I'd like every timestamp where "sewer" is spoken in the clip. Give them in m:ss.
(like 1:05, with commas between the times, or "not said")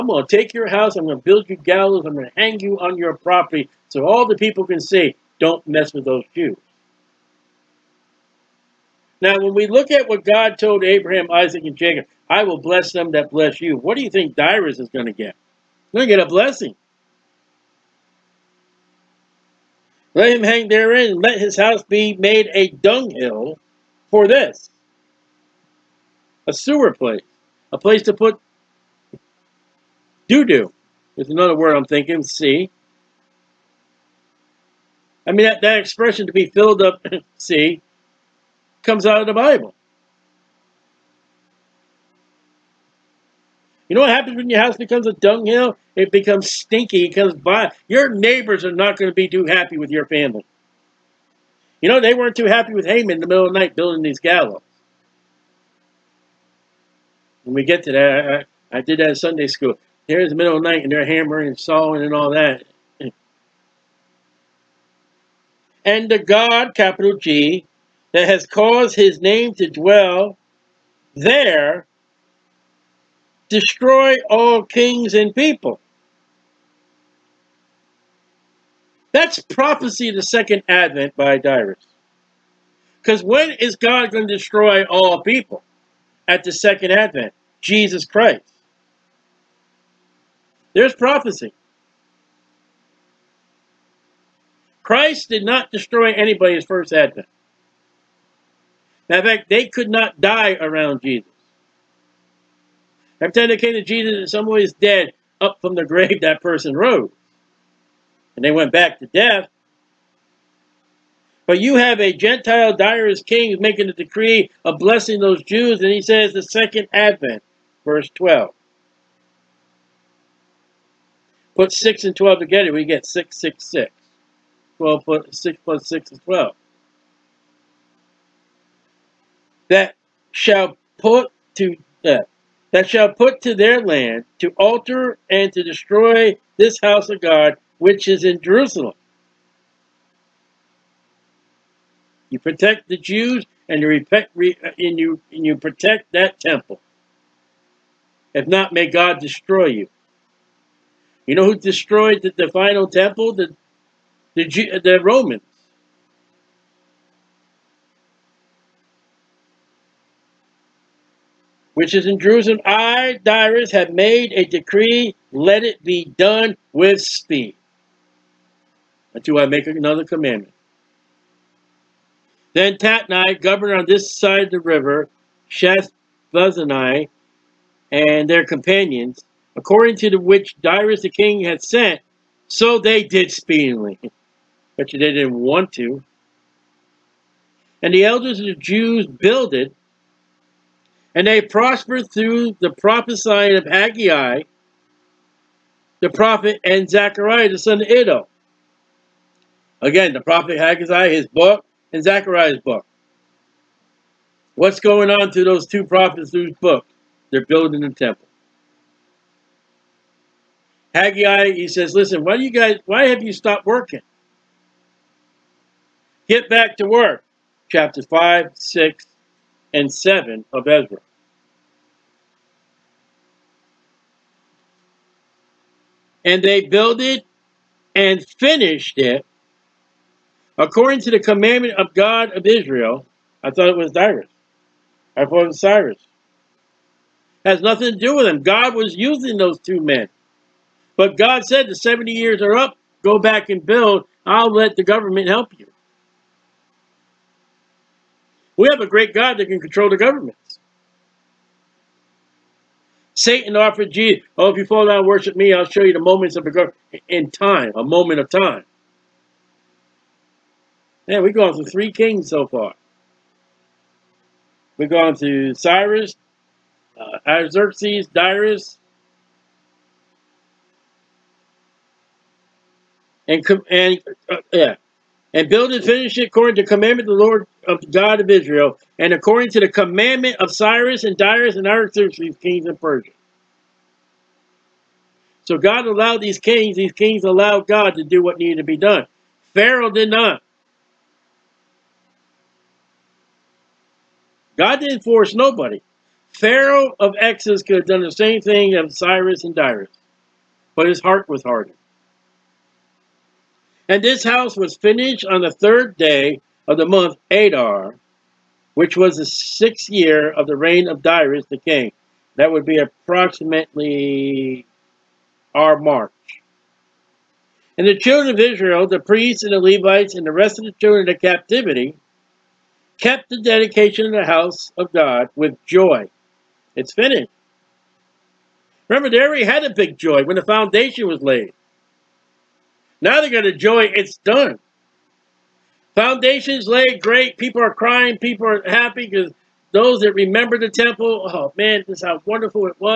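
0:26.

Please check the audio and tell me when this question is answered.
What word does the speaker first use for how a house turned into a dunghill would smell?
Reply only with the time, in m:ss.
0:46.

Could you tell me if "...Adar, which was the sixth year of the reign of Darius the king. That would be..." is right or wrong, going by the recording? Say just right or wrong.
right.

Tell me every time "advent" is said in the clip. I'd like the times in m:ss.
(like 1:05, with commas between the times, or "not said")
1:20, 1:26, 1:36, 1:56.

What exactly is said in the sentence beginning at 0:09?
Now, when we look at what God told Abraham, Isaac, and Jacob, I will bless them that bless you.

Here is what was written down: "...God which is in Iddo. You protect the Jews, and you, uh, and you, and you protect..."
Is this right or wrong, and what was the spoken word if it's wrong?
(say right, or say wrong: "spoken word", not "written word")
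wrong: "Jerusalem", not "Iddo".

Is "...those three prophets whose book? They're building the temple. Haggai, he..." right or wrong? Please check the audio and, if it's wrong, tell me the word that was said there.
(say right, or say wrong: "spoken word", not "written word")
wrong: "two", not "three".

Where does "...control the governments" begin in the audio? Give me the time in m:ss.
4:09.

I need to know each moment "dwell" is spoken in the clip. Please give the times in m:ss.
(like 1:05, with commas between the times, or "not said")
1:09.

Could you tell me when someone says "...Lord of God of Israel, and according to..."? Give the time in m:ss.
4:37.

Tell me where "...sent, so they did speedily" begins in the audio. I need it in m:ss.
3:01.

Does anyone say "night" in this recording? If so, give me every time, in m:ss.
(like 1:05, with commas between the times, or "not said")
0:53, 1:00.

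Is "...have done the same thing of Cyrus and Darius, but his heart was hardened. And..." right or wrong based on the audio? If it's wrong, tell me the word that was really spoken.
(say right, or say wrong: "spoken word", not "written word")
right.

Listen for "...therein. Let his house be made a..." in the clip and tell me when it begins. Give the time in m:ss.
0:20.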